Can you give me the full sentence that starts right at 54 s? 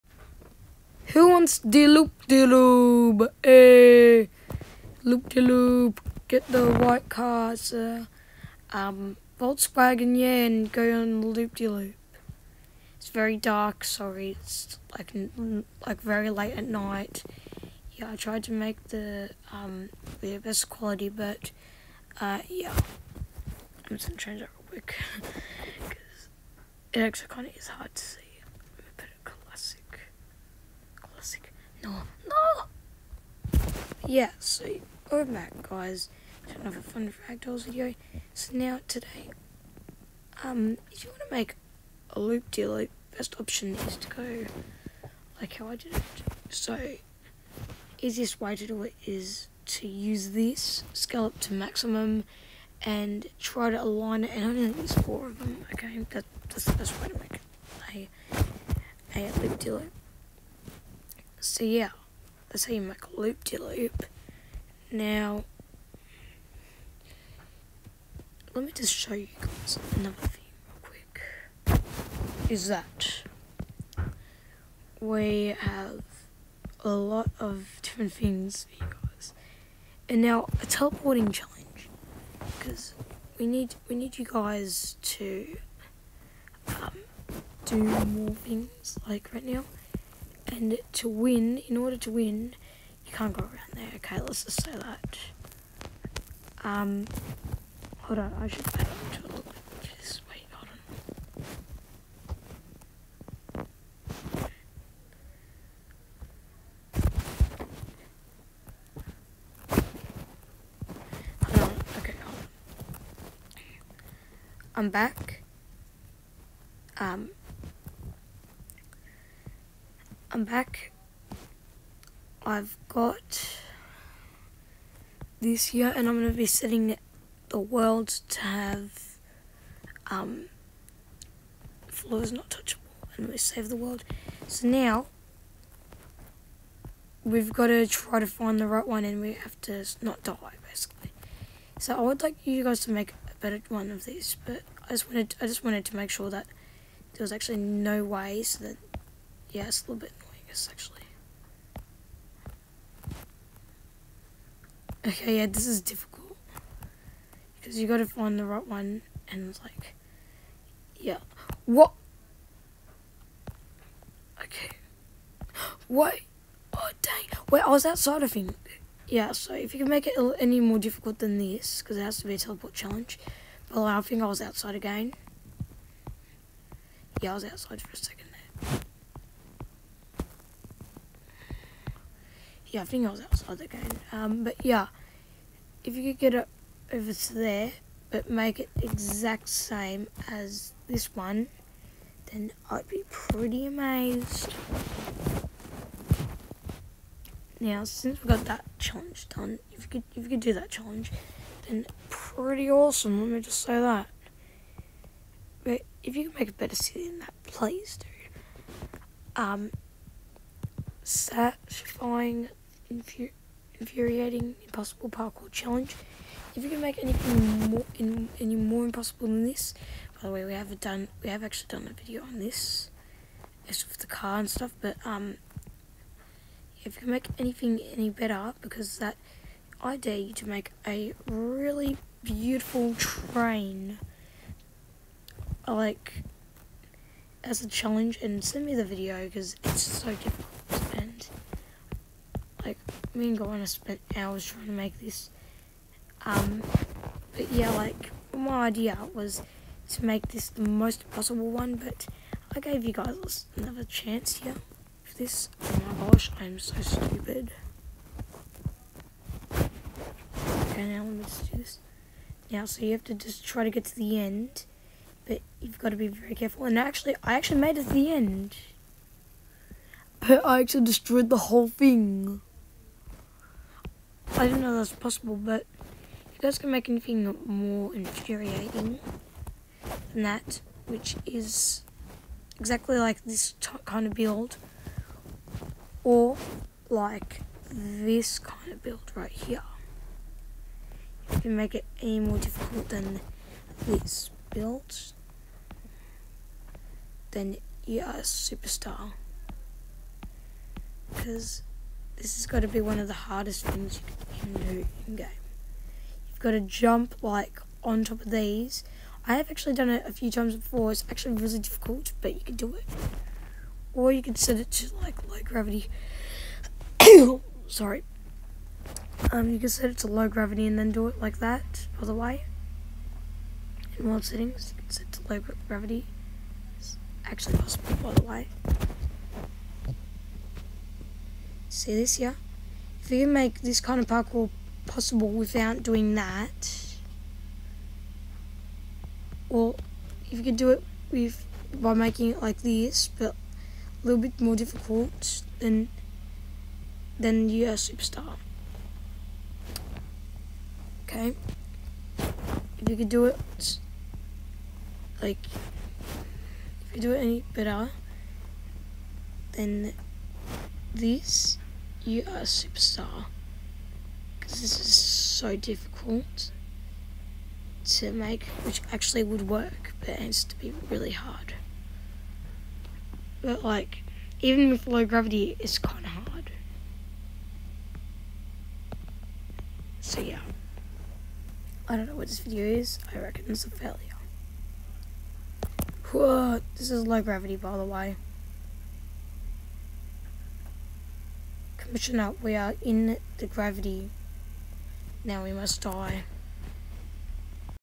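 And only use four of them, okay?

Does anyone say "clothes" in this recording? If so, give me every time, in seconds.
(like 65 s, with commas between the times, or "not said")
not said.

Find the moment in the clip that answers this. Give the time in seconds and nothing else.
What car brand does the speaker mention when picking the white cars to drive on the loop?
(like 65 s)
9 s.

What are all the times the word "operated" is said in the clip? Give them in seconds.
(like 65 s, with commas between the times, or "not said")
not said.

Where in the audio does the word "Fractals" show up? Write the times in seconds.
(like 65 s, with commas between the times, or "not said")
37 s.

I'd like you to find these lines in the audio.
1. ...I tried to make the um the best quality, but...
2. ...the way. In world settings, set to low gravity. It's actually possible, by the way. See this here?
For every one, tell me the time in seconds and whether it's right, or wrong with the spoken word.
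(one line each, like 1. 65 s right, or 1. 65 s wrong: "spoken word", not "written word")
1. 18 s right
2. 322 s right.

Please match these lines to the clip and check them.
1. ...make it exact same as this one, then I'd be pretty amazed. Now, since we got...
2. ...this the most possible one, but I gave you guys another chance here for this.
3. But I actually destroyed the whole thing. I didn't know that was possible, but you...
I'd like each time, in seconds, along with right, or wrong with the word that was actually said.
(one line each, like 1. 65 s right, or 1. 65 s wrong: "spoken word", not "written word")
1. 188 s right
2. 250 s right
3. 270 s right.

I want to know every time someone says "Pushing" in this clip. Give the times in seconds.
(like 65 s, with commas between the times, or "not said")
391 s.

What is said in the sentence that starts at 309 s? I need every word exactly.
I have actually done it a few times before.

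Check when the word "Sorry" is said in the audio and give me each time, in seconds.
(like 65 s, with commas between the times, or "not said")
13 s, 317 s.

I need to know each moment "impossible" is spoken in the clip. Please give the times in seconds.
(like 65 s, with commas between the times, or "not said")
214 s, 218 s.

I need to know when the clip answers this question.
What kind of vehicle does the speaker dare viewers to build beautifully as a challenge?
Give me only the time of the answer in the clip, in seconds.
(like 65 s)
232 s.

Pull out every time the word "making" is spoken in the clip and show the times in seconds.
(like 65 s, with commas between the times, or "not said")
341 s.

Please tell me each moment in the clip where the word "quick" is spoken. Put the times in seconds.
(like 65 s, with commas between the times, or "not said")
24 s, 70 s.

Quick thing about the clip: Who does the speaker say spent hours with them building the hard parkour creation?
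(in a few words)
Gwen.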